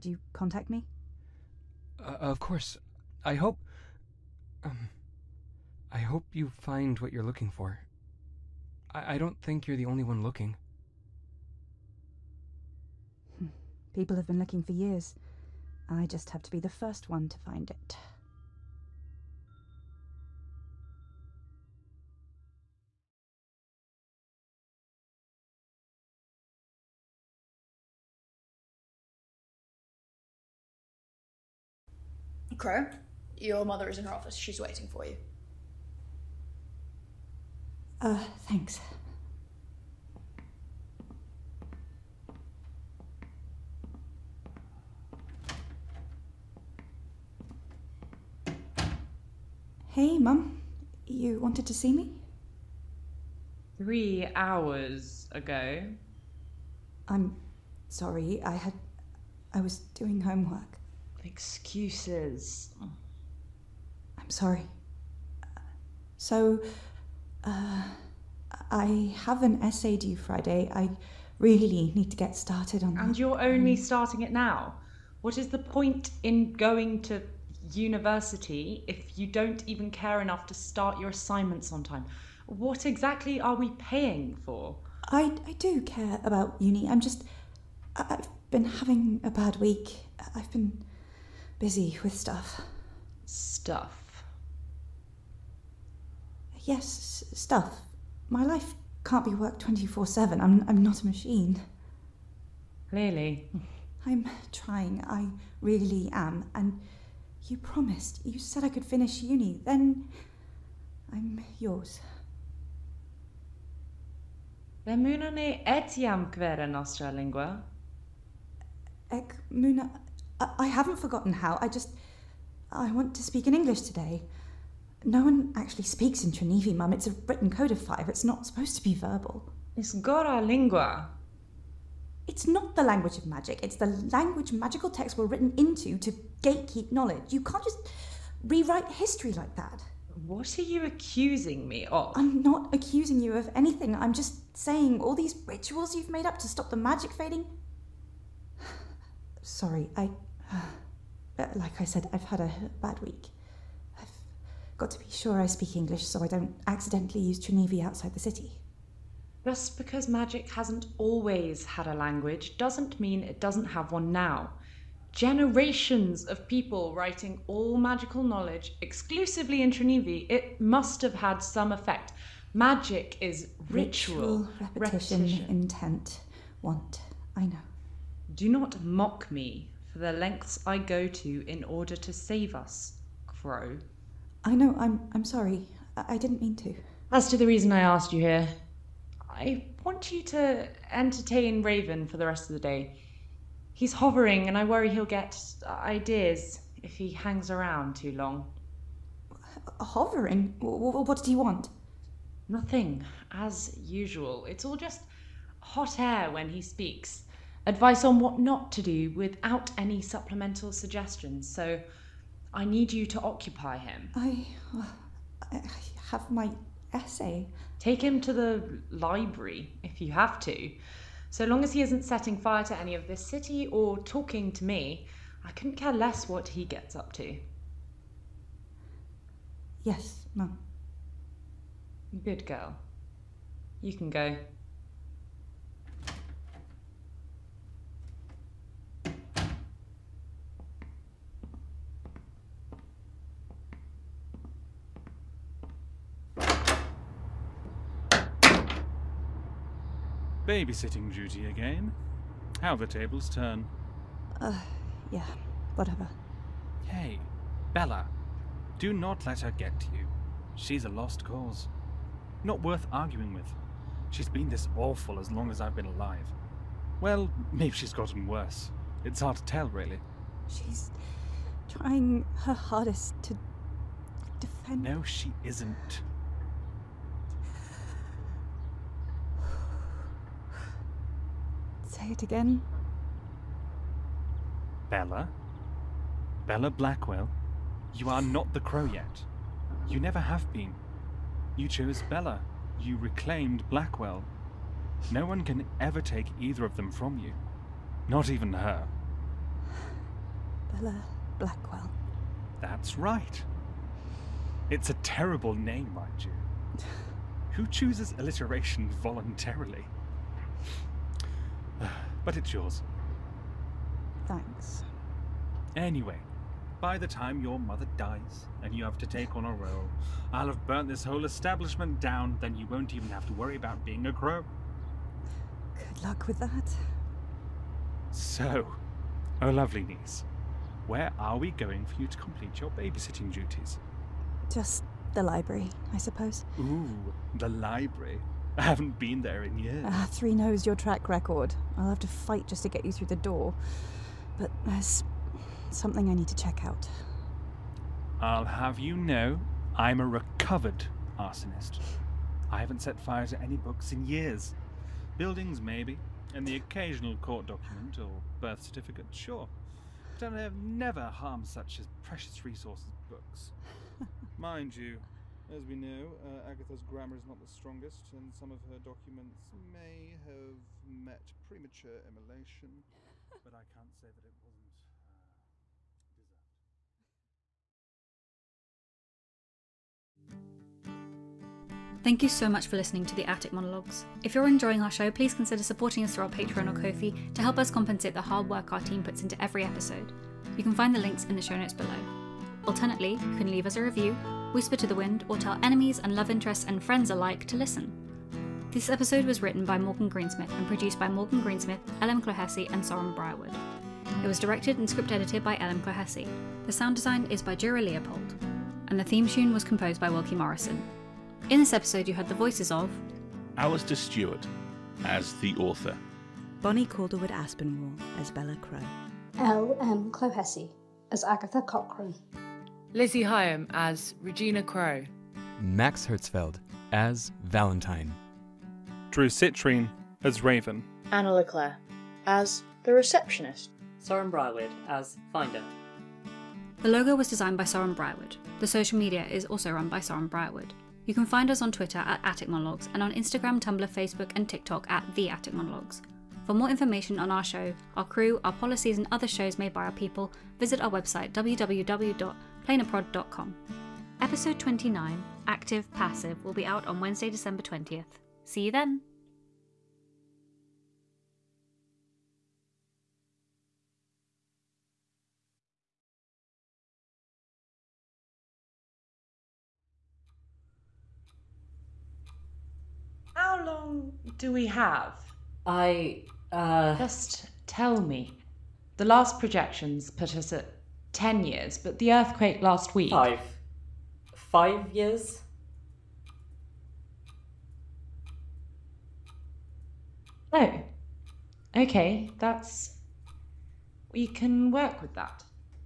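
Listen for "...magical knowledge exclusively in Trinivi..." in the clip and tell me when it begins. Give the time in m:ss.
2:47.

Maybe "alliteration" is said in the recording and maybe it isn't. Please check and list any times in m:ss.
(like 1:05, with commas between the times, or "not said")
5:08.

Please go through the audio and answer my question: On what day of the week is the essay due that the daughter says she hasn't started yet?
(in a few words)
Friday.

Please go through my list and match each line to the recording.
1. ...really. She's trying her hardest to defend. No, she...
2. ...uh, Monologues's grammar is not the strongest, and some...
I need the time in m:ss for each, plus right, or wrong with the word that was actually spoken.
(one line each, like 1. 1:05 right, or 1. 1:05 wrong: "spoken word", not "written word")
1. 4:29 right
2. 6:06 wrong: "Agatha", not "Monologues".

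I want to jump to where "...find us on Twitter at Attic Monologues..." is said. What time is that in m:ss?
7:21.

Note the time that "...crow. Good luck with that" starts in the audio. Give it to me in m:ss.
5:24.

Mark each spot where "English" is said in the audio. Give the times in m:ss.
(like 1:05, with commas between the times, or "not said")
2:03, 2:35.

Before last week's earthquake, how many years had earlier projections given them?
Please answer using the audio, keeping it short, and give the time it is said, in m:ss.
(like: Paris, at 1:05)
10, at 8:01.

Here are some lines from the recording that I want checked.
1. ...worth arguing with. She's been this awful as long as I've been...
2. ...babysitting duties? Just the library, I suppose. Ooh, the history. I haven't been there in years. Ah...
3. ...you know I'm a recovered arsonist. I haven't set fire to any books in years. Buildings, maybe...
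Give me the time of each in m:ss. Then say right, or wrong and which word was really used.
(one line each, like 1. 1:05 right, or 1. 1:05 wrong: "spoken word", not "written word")
1. 4:22 right
2. 5:32 wrong: "library", not "history"
3. 5:48 right.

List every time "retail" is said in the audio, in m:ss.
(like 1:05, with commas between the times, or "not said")
not said.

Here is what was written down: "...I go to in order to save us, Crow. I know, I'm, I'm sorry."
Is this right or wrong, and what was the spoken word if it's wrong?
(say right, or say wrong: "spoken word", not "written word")
right.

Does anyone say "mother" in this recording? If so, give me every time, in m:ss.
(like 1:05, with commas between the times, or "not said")
0:33, 5:17.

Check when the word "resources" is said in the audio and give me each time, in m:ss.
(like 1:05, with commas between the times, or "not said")
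6:02.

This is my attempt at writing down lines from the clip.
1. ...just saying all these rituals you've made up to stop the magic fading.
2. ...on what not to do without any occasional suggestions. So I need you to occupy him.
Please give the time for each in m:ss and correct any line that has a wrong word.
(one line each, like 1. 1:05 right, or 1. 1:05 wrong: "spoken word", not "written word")
1. 2:24 right
2. 3:28 wrong: "supplemental", not "occasional".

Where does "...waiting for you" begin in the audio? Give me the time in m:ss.
0:34.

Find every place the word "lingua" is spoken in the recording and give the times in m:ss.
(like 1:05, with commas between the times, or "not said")
1:57, 2:10.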